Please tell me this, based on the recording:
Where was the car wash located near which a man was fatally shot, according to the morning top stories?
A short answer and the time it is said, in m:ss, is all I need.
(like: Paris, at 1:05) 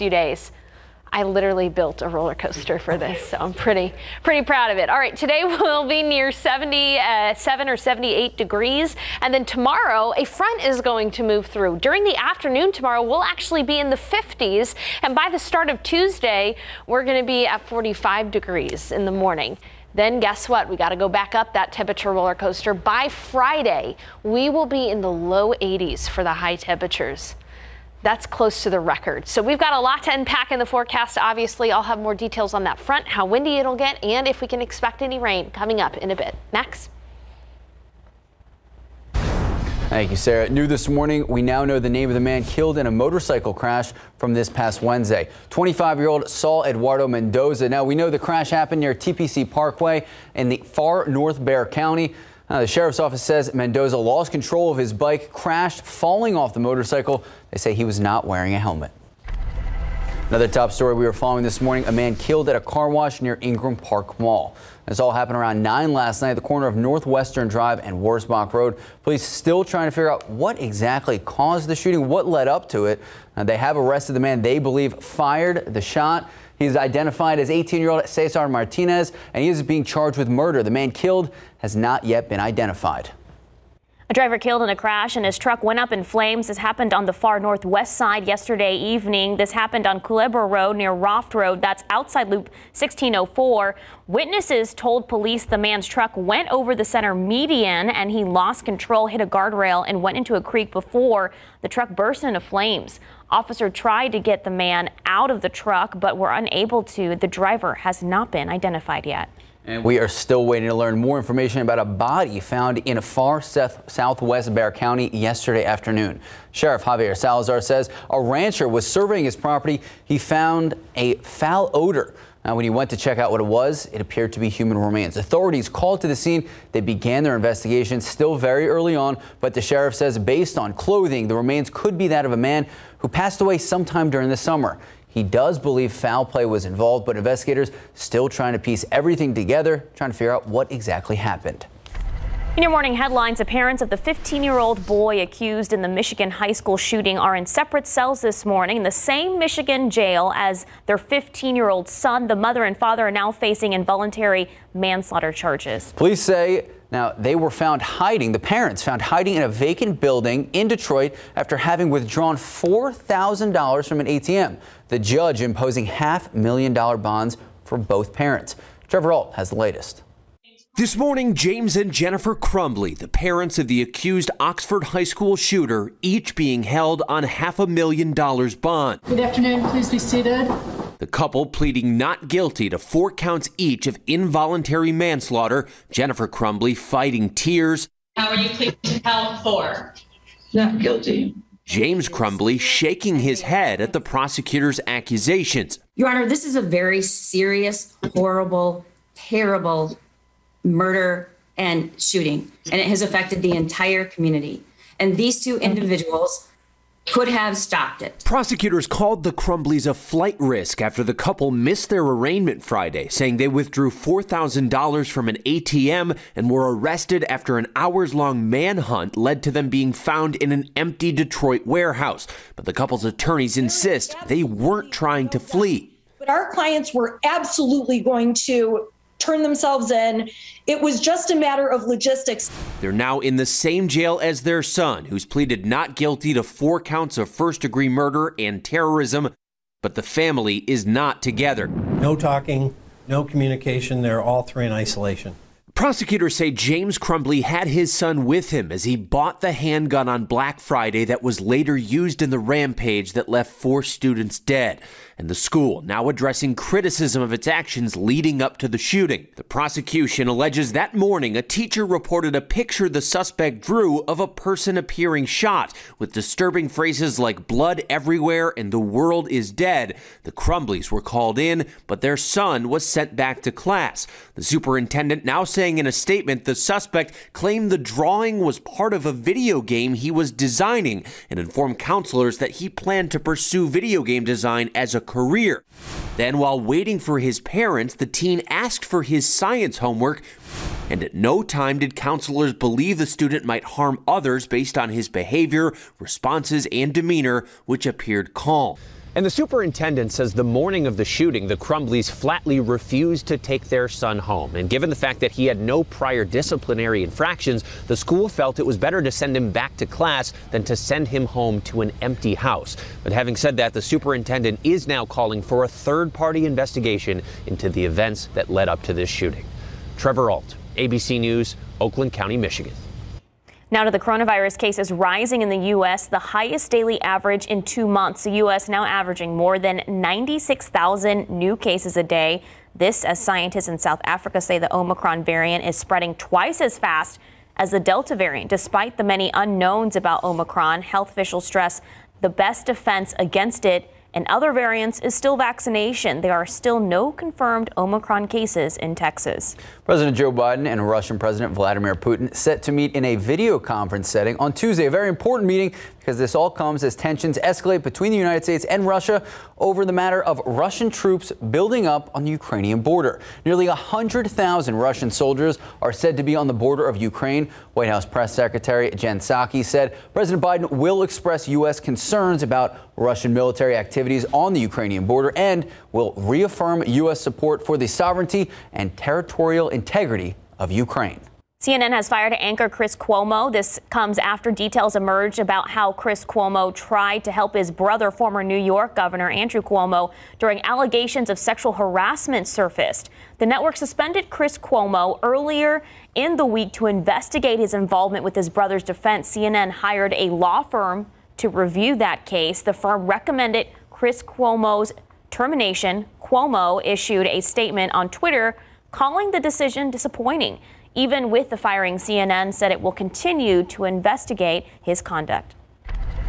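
Ingram Park Mall, at 1:03.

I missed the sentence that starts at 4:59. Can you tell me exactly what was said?
And the superintendent says the morning of the shooting, the Crumbleys flatly refused to take their son home.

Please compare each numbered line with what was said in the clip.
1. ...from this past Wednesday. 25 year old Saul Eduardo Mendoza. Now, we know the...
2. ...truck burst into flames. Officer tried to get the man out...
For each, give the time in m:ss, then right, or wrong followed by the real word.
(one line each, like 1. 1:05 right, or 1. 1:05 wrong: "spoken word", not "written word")
1. 0:44 right
2. 1:41 right.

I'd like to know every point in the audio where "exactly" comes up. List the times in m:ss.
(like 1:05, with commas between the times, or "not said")
1:10, 2:20.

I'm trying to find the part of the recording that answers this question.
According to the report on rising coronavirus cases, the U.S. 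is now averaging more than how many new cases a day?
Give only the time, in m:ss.
5:29.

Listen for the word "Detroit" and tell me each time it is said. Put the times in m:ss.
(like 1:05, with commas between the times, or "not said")
2:40, 3:41.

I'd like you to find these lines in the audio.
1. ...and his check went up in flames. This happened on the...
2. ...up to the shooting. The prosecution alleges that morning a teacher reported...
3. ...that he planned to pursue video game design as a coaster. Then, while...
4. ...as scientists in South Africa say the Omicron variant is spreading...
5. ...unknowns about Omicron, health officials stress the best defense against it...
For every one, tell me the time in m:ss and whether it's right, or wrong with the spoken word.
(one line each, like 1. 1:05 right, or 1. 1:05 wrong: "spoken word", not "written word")
1. 1:25 wrong: "truck", not "check"
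2. 4:18 right
3. 4:42 wrong: "career", not "coaster"
4. 5:33 right
5. 5:39 right.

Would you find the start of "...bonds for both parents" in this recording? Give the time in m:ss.
2:46.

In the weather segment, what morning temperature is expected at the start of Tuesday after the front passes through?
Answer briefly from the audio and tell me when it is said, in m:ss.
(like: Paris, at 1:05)
45 degrees, at 0:17.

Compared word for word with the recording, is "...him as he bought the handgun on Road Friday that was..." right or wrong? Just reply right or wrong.
wrong.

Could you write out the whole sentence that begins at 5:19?
Trevor Alt, ABC News, Oakland County, Michigan.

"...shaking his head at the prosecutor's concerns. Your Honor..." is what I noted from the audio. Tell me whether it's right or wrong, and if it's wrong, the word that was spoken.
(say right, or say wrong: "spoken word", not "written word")
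wrong: "accusations", not "concerns".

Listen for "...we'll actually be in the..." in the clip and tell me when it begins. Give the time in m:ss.
0:13.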